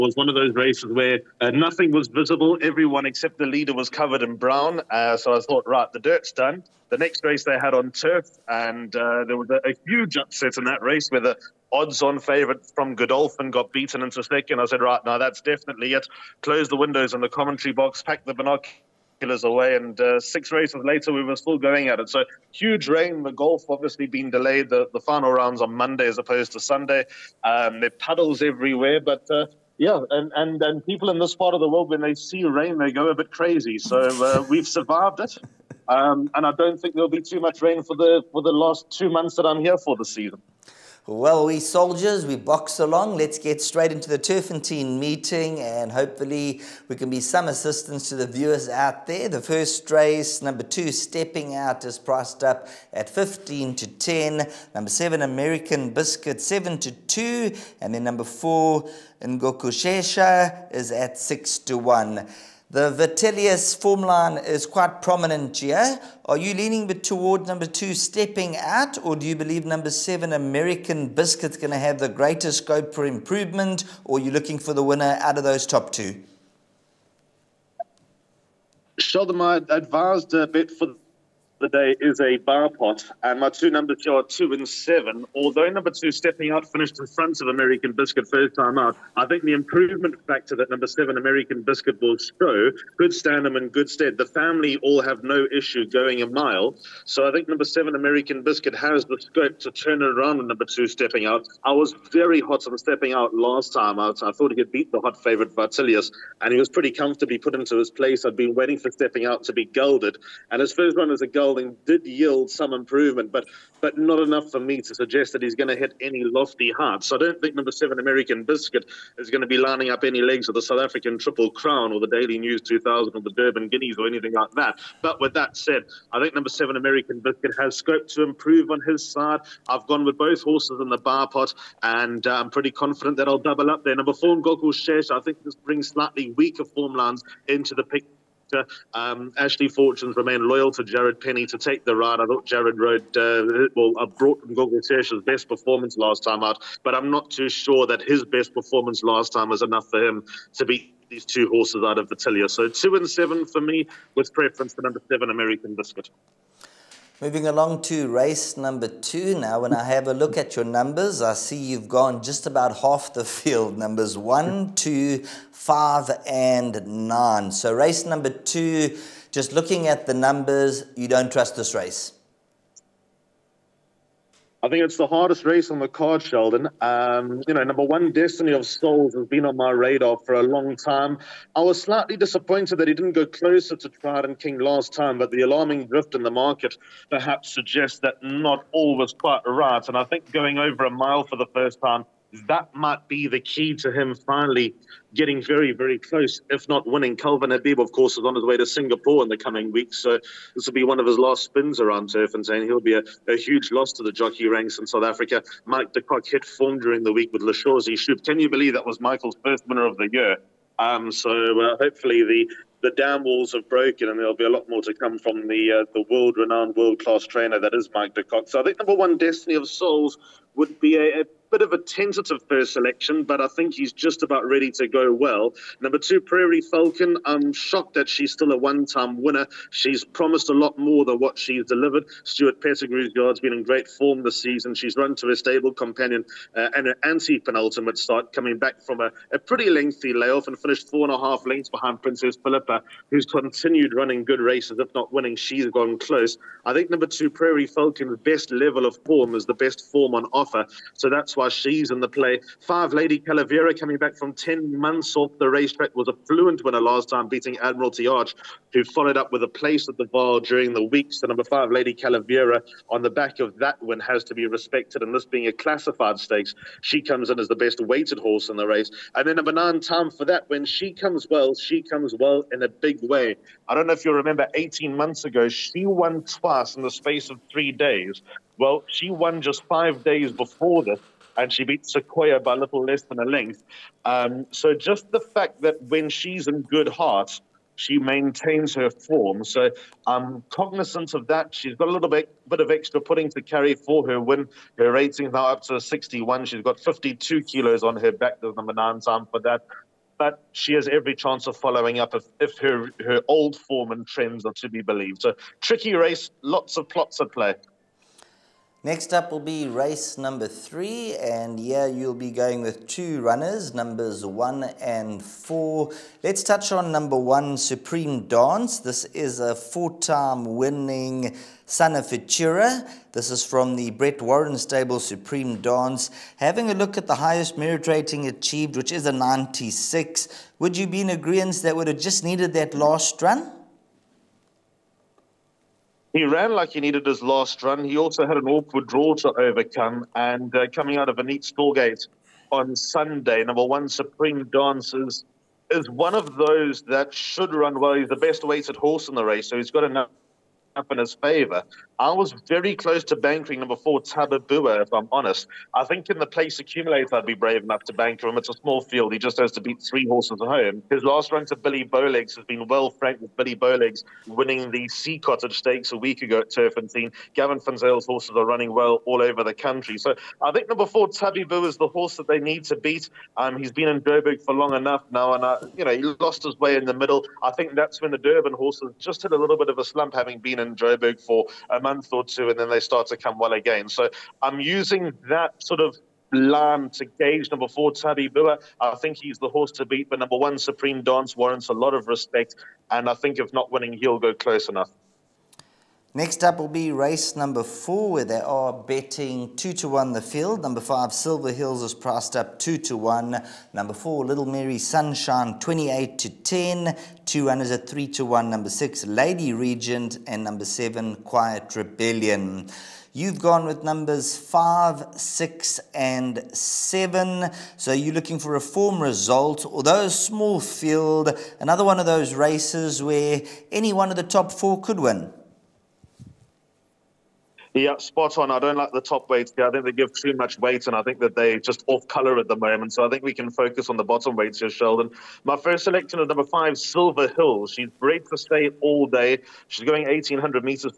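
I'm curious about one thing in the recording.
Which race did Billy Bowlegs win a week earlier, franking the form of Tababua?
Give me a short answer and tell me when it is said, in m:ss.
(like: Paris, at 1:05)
Sea Cottage Stakes, at 6:04.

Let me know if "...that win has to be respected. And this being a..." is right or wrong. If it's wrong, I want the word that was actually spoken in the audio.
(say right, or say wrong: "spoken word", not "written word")
right.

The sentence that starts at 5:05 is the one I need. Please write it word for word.
So tricky race, lots of plots at play.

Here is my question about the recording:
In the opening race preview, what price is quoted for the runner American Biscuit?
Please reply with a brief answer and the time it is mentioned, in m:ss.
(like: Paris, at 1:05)
7 to 2, at 0:56.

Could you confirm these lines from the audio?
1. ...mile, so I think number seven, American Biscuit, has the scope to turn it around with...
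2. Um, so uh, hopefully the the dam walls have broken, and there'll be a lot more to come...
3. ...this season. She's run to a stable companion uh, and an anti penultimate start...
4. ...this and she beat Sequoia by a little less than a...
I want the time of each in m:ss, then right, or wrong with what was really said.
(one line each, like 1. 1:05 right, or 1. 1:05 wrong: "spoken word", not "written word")
1. 1:36 right
2. 3:30 right
3. 3:54 right
4. 4:40 right.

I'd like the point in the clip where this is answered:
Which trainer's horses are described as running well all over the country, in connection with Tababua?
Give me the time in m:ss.
6:07.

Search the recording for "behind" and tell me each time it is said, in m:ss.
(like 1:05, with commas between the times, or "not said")
4:01.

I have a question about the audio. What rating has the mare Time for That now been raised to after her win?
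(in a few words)
61.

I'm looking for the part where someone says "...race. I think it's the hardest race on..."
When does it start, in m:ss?
2:51.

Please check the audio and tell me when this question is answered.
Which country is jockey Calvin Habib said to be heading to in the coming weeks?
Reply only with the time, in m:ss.
3:18.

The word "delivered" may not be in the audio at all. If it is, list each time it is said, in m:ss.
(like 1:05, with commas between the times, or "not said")
3:51.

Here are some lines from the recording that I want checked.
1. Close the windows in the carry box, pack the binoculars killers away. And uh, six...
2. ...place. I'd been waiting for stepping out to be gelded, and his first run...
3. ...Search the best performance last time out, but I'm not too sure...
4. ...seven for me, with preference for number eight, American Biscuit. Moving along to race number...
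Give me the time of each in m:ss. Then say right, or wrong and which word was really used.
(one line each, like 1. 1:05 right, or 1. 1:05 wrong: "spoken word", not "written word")
1. 0:16 wrong: "commentary", not "carry"
2. 1:47 right
3. 2:24 right
4. 2:33 wrong: "seven", not "eight".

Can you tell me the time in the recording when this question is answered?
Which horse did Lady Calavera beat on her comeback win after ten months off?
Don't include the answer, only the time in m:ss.
4:17.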